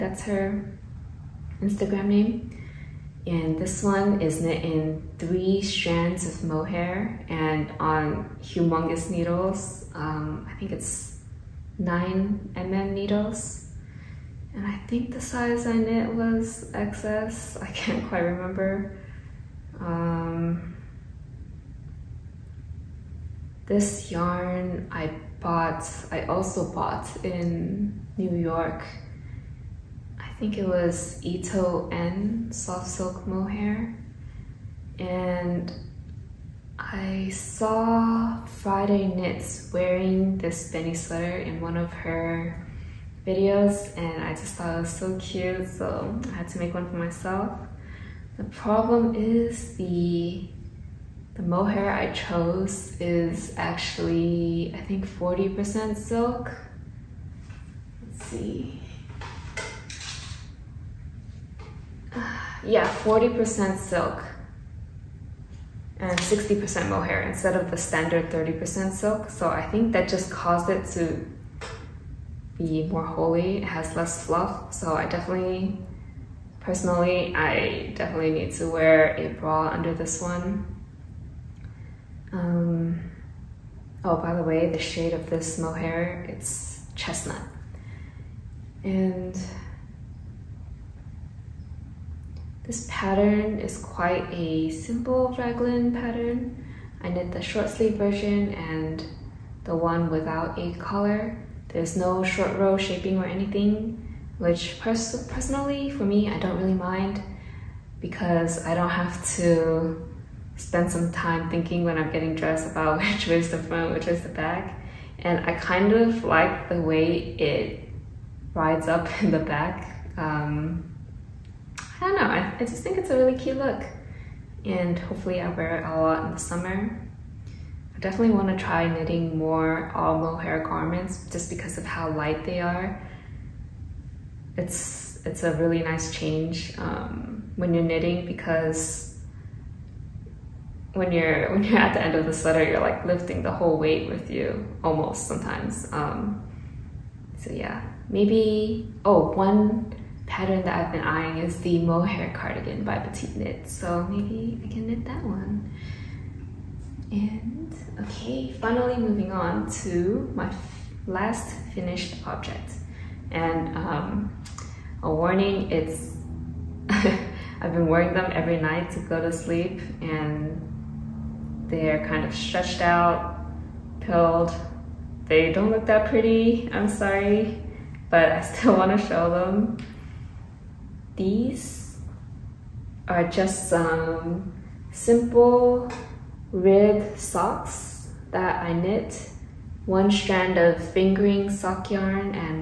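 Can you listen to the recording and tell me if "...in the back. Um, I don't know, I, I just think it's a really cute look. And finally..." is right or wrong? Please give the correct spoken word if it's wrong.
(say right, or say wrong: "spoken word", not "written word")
wrong: "hopefully", not "finally".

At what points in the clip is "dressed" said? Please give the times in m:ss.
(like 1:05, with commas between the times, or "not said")
1:52.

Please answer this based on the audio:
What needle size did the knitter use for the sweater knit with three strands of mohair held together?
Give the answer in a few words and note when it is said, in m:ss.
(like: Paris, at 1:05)
9 mm, at 0:11.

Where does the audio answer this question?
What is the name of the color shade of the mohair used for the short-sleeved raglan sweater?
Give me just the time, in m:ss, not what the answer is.
1:26.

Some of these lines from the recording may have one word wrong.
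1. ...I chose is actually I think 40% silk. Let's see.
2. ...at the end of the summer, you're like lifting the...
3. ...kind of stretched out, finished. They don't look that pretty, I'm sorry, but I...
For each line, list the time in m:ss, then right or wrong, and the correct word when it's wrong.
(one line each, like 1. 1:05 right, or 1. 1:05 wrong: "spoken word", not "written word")
1. 0:51 right
2. 2:21 wrong: "sweater", not "summer"
3. 2:52 wrong: "pilled", not "finished".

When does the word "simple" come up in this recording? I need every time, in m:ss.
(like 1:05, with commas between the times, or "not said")
1:34, 3:04.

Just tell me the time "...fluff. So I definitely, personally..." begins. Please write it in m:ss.
1:14.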